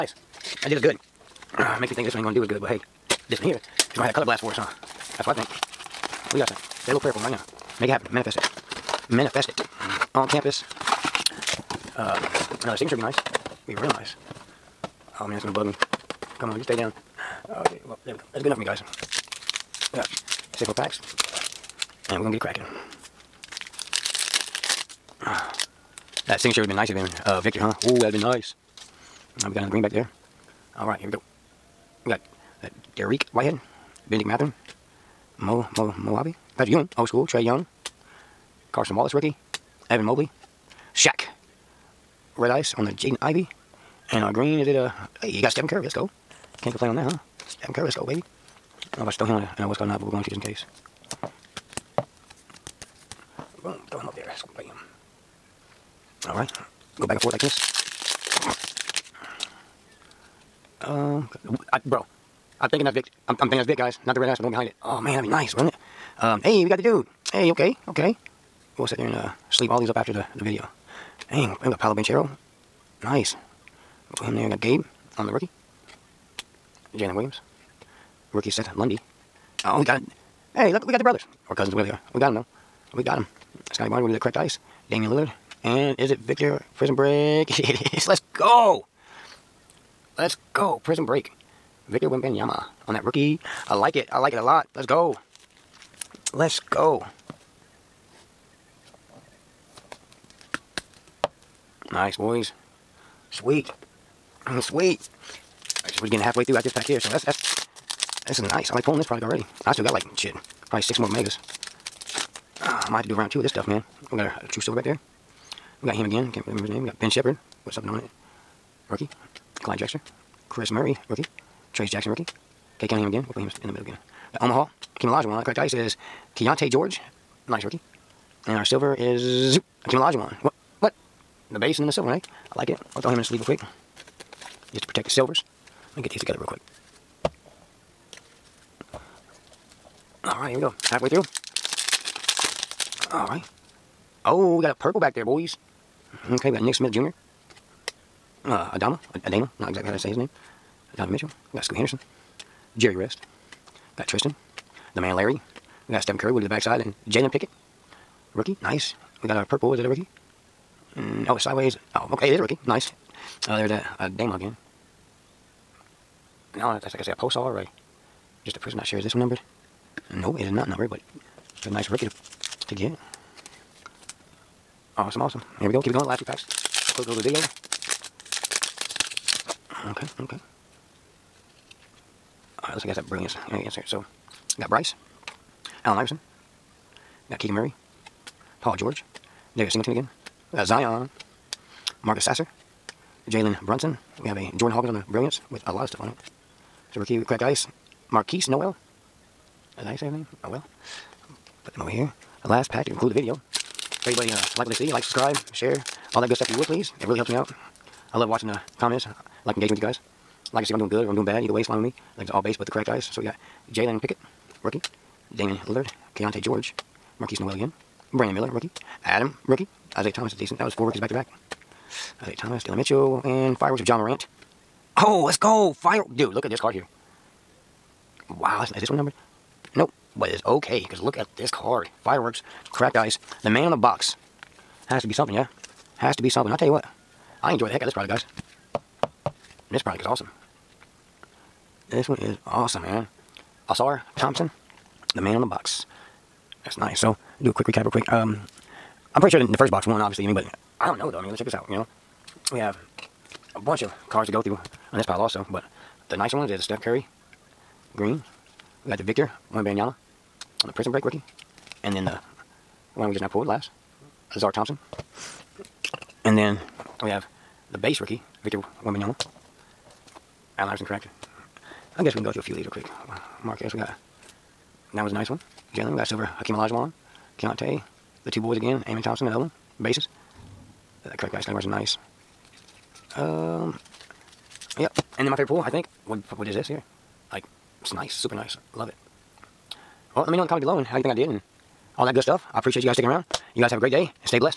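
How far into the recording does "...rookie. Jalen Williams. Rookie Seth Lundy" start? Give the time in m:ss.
1:15.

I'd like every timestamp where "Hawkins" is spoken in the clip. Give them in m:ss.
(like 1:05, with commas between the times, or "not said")
3:14.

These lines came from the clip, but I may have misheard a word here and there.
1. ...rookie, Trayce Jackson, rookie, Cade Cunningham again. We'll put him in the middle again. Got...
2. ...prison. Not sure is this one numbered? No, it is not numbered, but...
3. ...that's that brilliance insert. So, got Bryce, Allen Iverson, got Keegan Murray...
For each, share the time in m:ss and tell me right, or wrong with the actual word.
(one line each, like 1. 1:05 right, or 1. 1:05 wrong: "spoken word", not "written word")
1. 2:01 right
2. 2:48 right
3. 3:02 right.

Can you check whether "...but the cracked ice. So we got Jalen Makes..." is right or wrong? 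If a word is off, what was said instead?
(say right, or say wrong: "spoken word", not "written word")
wrong: "Pickett", not "Makes".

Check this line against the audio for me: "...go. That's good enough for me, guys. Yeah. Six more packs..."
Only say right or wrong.
right.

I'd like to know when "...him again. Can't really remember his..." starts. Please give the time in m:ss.
1:55.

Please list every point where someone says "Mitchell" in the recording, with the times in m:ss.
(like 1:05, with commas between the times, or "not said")
2:31, 3:42.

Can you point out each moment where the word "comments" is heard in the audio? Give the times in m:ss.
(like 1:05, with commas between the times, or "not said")
3:28, 4:50.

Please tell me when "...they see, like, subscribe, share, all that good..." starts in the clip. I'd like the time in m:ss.
3:24.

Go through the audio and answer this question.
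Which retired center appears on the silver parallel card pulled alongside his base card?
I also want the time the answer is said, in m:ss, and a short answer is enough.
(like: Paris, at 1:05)
Hakeem Olajuwon, at 2:09.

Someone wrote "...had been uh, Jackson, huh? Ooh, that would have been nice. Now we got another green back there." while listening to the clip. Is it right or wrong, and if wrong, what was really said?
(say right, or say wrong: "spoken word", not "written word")
wrong: "Victor", not "Jackson".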